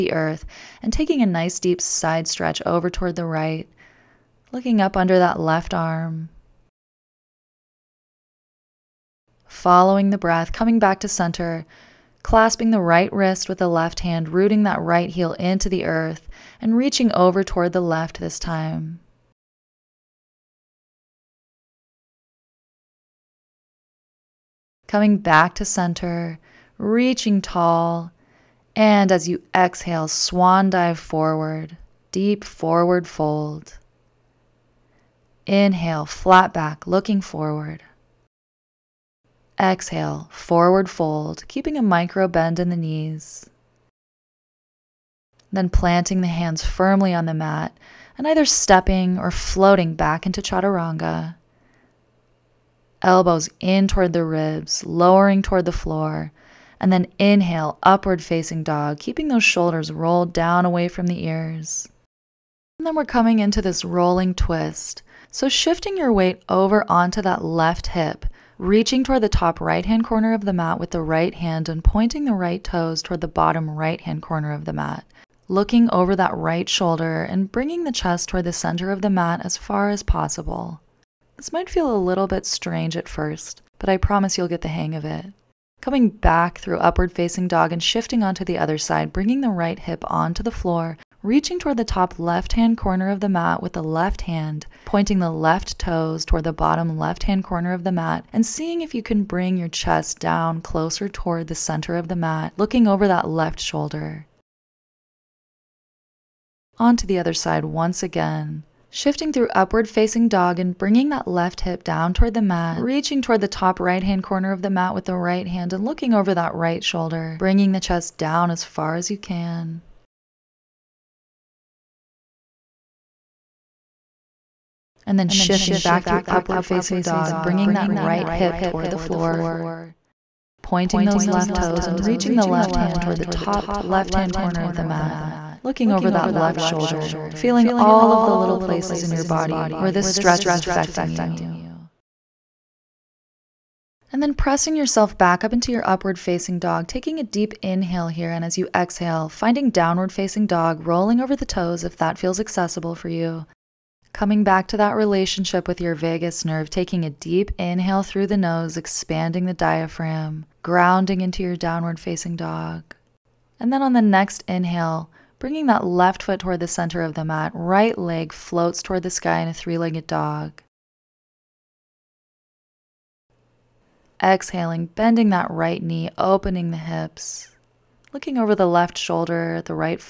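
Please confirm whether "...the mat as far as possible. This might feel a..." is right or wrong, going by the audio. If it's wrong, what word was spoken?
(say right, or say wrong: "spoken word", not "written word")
right.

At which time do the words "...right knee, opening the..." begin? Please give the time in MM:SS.
02:55.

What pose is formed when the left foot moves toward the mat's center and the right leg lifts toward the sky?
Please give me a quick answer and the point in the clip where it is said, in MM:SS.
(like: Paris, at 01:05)
three legged dog, at 02:49.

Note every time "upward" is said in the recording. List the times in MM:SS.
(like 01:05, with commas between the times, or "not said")
00:57, 01:26, 01:49, 02:06, 02:25.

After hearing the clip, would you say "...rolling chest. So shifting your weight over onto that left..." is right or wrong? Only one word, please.
wrong.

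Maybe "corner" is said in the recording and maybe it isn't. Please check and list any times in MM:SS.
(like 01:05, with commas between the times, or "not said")
01:10, 01:14, 01:32, 01:37, 01:54, 02:14.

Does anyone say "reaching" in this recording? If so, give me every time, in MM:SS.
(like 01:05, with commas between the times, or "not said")
00:16, 00:26, 01:08, 01:31, 01:52, 02:12.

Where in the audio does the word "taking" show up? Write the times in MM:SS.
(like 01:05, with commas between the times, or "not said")
00:00, 02:26, 02:36.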